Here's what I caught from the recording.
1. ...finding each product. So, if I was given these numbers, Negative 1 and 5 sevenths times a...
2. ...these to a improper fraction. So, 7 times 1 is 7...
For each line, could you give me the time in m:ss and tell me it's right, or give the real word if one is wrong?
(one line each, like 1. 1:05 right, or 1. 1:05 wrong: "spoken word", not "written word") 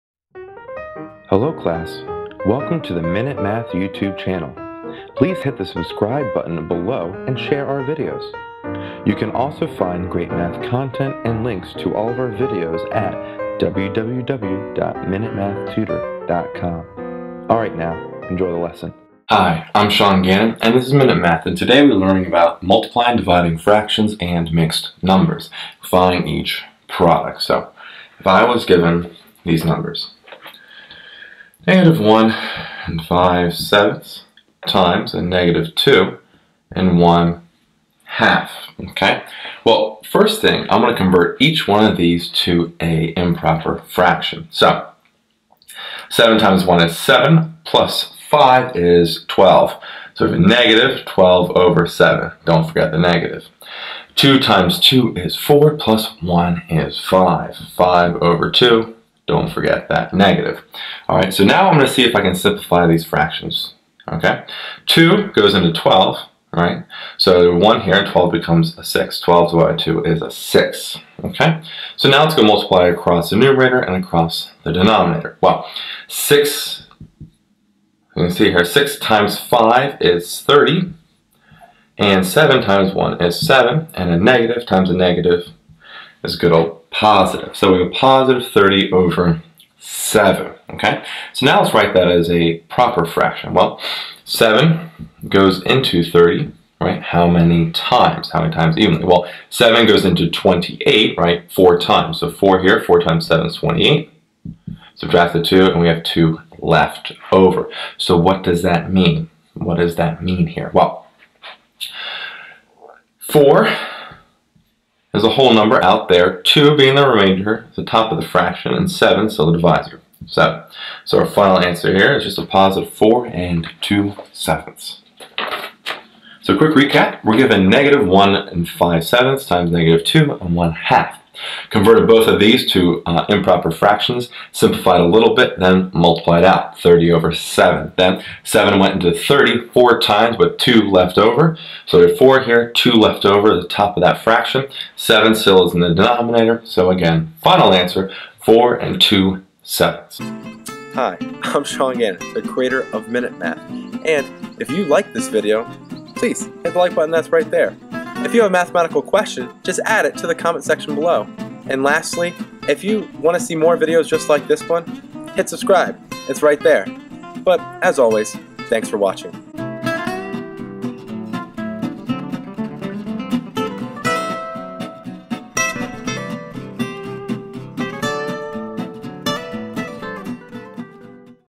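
1. 0:25 right
2. 0:41 right.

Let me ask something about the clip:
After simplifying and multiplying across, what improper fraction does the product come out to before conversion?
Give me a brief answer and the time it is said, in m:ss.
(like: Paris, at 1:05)
30/7, at 1:27.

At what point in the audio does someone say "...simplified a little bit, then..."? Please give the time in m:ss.
2:14.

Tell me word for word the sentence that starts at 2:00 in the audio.
So, So our final answer here is just a positive 4 and 2 sevenths.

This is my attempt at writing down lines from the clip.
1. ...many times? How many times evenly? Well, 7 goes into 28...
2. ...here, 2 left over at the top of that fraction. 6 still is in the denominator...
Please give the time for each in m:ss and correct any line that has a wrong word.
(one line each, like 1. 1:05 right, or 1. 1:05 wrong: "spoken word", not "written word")
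1. 1:37 right
2. 2:22 wrong: "7", not "6".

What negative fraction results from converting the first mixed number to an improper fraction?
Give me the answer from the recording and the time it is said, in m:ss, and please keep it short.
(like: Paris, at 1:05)
-12/7, at 0:50.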